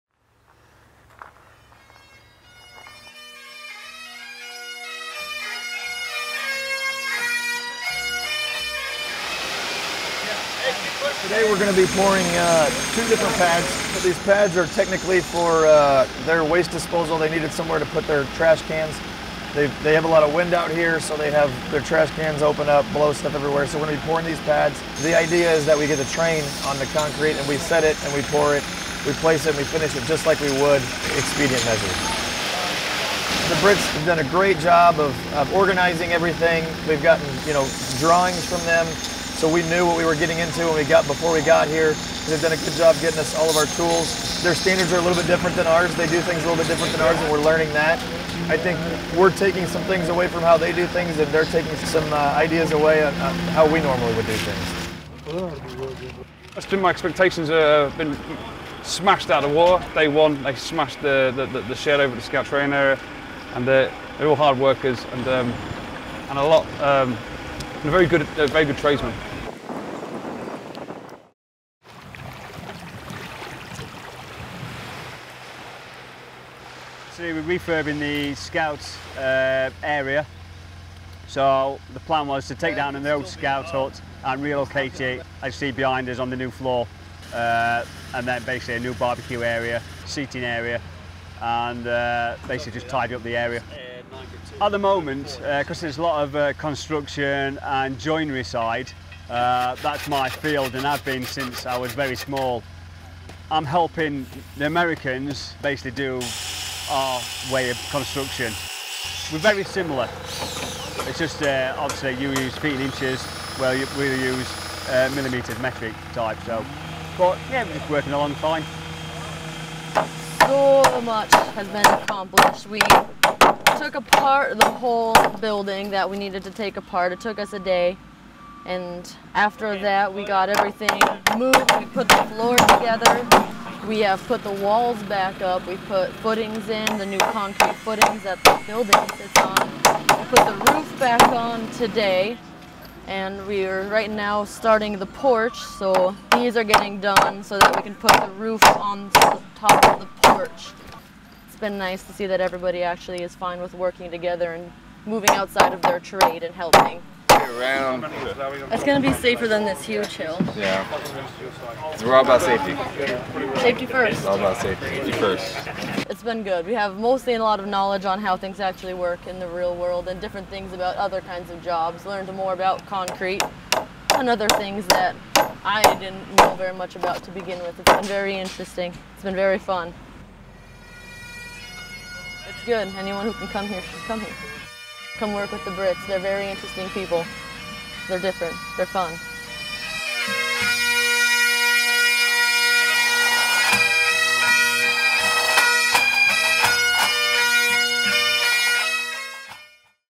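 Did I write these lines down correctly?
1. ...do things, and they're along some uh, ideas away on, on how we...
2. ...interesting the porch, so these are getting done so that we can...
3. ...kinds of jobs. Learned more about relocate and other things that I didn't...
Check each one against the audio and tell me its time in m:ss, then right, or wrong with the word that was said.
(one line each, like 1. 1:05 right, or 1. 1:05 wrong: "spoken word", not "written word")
1. 0:50 wrong: "taking", not "along"
2. 2:24 wrong: "starting", not "interesting"
3. 2:51 wrong: "concrete", not "relocate".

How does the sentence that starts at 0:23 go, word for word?
So we're going to be pouring these pads.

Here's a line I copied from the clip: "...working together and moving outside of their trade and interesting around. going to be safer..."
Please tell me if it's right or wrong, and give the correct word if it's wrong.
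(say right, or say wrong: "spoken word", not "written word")
wrong: "helping", not "interesting".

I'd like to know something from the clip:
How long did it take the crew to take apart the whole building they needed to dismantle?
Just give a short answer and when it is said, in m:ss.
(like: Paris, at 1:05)
a day, at 2:07.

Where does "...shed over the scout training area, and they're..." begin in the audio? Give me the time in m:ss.
1:01.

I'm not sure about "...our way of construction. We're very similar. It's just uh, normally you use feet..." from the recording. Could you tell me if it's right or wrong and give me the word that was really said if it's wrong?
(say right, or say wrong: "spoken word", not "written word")
wrong: "obviously", not "normally".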